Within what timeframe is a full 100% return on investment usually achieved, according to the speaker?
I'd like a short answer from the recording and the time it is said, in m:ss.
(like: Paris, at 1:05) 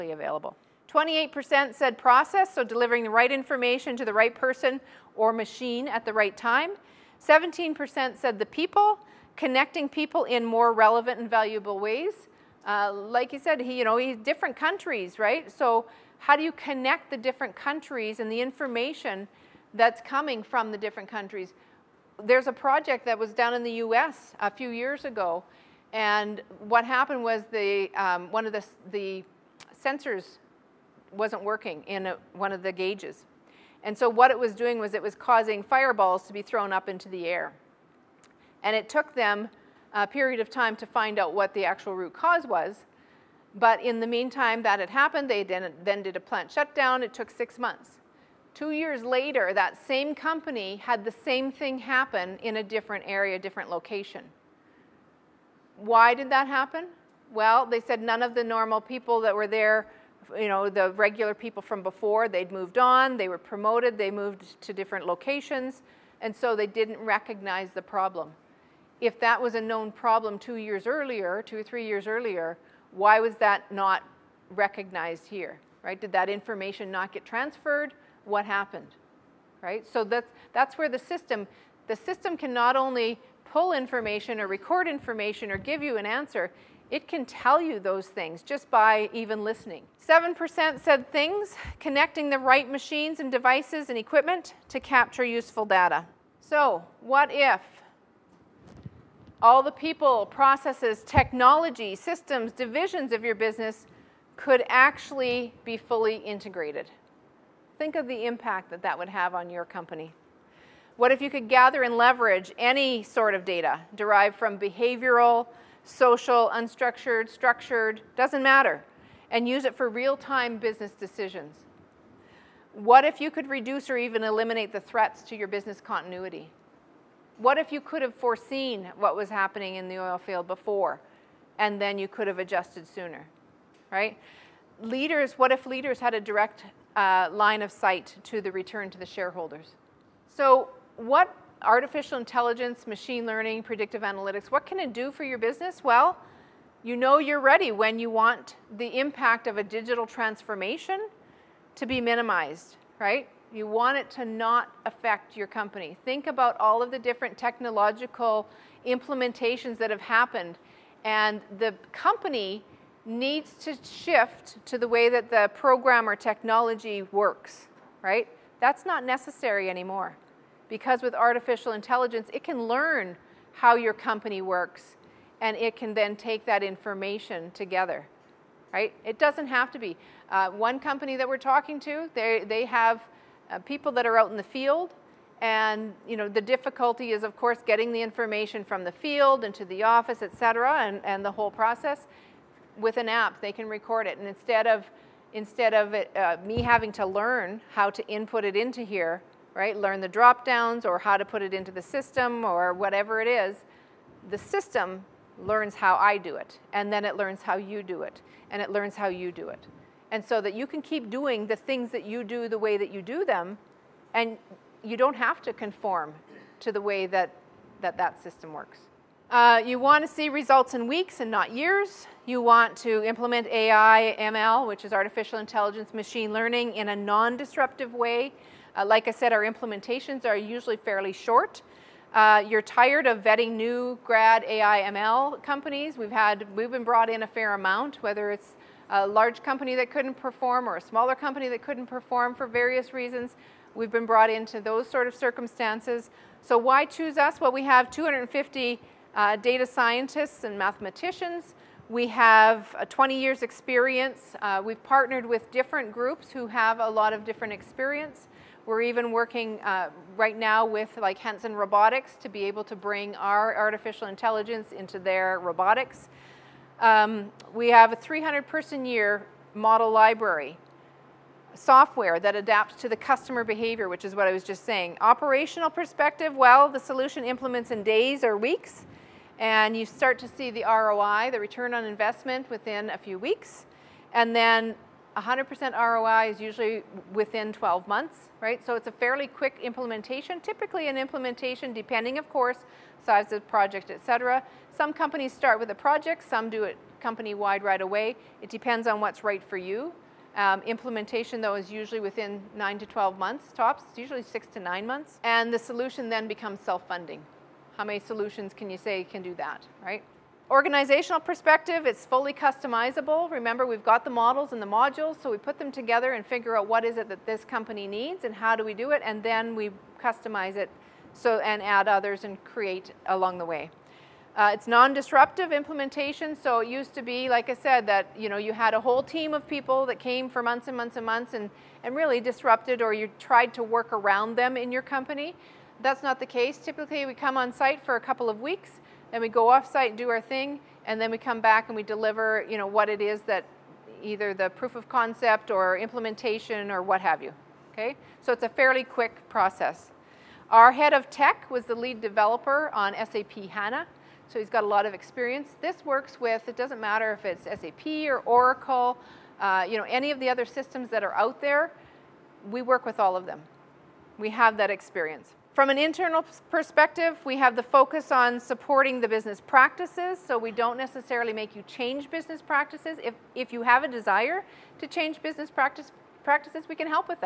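12 months, at 4:47.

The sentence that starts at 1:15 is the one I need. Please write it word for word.
Did that information not get transferred?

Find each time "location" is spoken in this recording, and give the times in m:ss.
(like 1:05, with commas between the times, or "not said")
0:53, 1:05.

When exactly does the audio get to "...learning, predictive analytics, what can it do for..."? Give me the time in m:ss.
2:23.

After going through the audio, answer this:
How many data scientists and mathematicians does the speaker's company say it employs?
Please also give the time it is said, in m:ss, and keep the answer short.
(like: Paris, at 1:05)
250, at 4:07.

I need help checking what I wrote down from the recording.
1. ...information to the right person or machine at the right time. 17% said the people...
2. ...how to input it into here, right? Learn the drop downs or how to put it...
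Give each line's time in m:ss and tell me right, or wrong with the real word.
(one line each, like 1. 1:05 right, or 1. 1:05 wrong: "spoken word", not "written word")
1. 0:03 right
2. 3:17 right.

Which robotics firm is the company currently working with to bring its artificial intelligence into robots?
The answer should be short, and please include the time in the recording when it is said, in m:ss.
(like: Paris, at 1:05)
Hanson Robotics, at 4:21.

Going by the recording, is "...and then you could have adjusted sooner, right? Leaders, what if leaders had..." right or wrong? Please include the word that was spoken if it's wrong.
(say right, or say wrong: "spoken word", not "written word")
right.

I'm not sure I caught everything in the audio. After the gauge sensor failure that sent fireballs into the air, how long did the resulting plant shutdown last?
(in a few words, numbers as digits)
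Six months.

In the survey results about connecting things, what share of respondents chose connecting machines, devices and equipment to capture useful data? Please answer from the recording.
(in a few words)
7%.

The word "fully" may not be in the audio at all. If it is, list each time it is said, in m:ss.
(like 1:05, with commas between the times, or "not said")
1:45, 5:12.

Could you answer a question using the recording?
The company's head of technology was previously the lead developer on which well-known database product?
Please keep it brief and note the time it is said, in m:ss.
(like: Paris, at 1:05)
SAP HANA, at 5:52.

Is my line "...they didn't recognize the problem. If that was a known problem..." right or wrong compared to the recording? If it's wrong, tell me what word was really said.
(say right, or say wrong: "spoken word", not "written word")
right.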